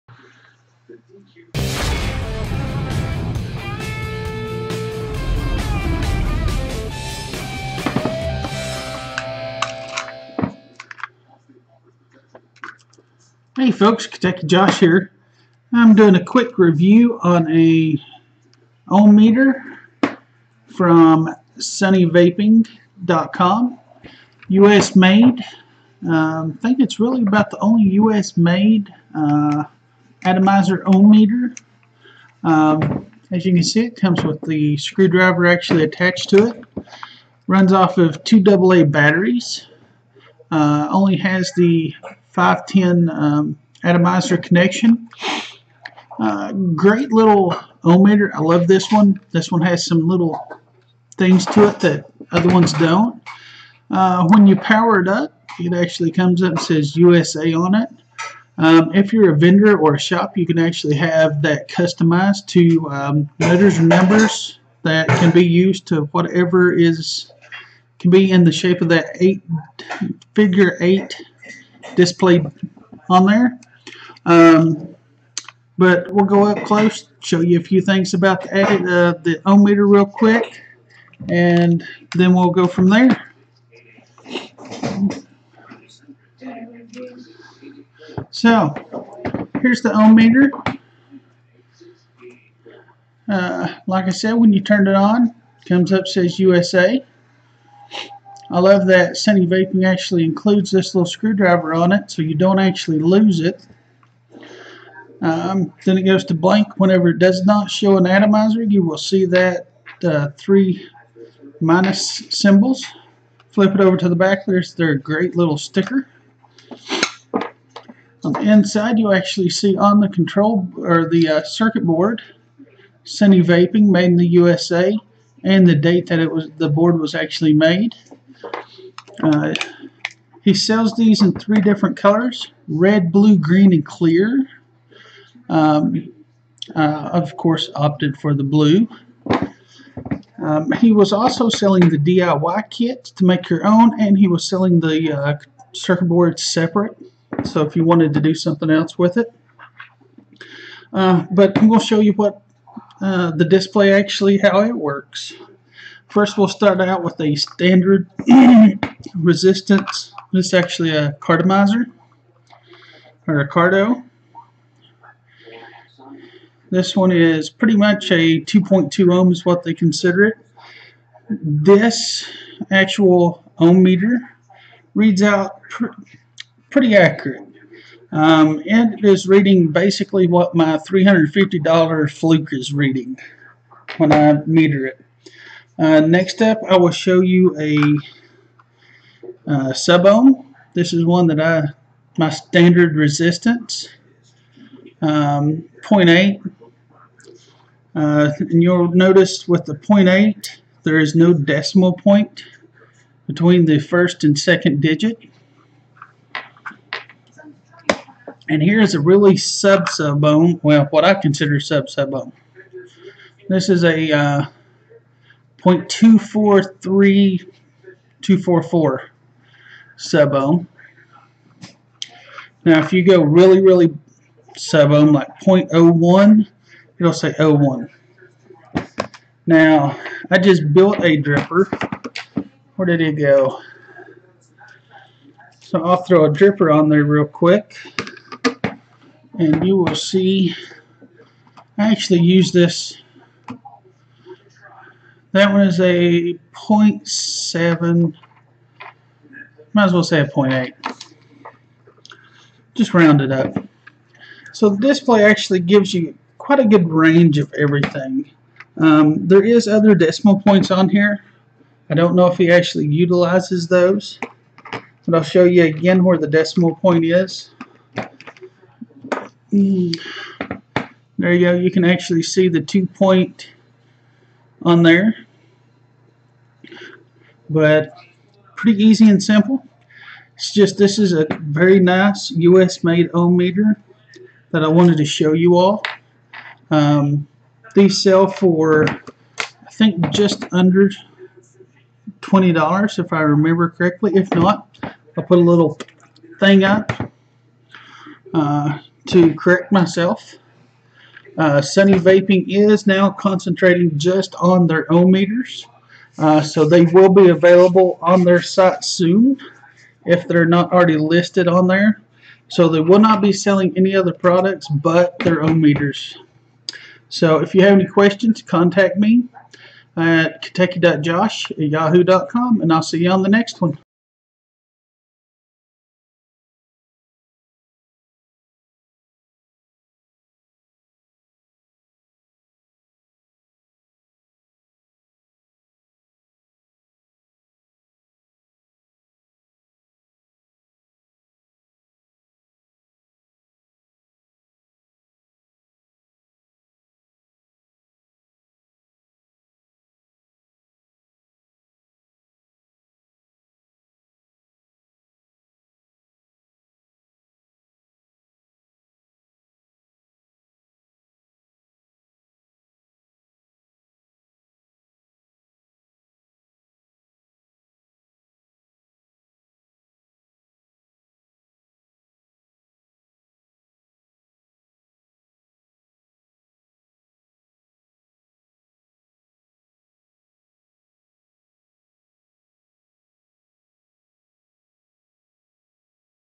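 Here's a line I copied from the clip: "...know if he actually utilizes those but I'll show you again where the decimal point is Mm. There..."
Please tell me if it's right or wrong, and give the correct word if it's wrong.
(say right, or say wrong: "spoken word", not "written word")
right.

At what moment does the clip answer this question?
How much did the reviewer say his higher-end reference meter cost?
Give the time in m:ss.
3:00.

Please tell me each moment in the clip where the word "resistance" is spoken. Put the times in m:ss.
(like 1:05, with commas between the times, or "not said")
2:39, 3:12.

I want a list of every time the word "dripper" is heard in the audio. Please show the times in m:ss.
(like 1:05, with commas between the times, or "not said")
3:51, 3:56.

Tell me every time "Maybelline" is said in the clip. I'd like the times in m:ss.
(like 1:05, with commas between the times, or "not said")
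not said.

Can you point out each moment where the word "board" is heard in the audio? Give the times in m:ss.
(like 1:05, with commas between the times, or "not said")
2:01, 2:06, 2:26.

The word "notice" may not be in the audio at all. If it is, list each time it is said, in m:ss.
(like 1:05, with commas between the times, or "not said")
3:18.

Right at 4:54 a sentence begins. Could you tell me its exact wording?
If not, I'll put a little thing up.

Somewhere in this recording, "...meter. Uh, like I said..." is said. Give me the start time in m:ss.
1:30.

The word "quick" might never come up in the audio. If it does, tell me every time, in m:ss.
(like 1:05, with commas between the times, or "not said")
0:16, 1:20, 3:57.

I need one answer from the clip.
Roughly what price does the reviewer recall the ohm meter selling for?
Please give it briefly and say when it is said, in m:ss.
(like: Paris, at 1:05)
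just under $20, at 4:50.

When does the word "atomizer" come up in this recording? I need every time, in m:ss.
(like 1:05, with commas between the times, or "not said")
0:30, 0:43, 1:48.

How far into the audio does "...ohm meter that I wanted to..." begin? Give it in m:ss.
4:43.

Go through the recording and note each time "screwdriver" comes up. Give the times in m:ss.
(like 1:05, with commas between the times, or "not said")
0:34, 1:41.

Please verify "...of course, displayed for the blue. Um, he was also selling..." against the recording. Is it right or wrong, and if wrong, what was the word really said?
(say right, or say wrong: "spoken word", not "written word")
wrong: "opted", not "displayed".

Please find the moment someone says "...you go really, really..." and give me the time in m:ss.
3:42.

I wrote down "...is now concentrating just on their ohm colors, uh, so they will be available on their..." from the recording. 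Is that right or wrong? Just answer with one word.
wrong.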